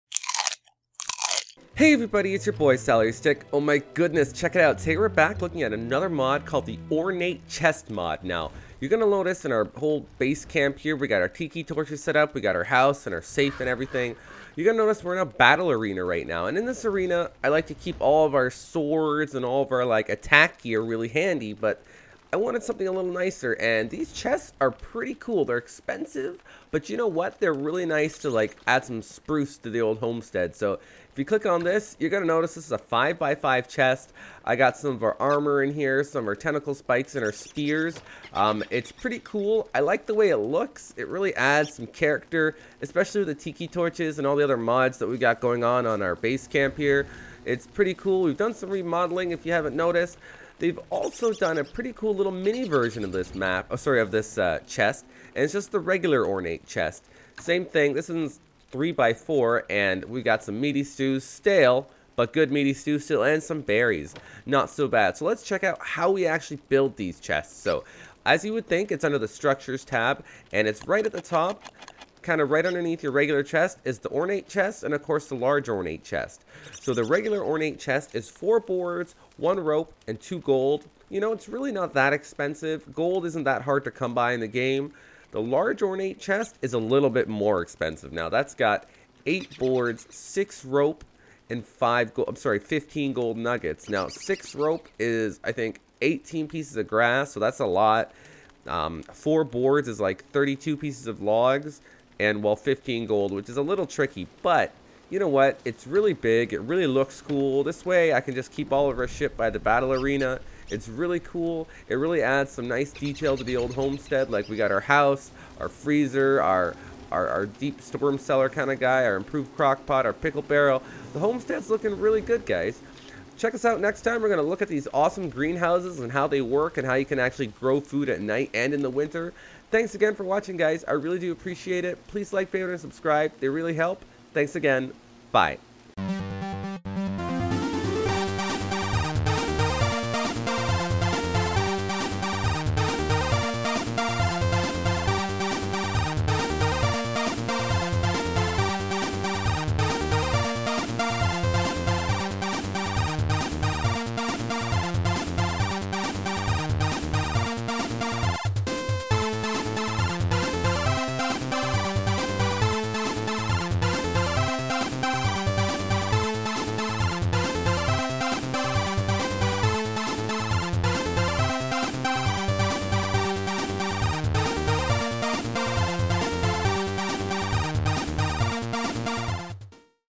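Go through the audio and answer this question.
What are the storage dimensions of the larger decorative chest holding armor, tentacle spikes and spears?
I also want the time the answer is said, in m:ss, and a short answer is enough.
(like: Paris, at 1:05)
5x5, at 0:32.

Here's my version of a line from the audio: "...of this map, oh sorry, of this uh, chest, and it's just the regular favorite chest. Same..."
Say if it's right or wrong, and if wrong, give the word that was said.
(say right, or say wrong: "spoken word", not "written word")
wrong: "ornate", not "favorite".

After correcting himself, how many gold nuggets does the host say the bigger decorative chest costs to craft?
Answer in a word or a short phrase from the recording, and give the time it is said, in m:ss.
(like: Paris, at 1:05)
15, at 1:32.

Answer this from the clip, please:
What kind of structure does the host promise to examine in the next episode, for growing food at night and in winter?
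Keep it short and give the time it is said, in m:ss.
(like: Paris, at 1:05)
Greenhouses, at 2:05.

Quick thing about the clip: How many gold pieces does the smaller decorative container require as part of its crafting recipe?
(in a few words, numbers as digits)
2.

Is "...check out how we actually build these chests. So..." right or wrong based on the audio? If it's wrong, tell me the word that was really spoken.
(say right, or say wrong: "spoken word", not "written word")
right.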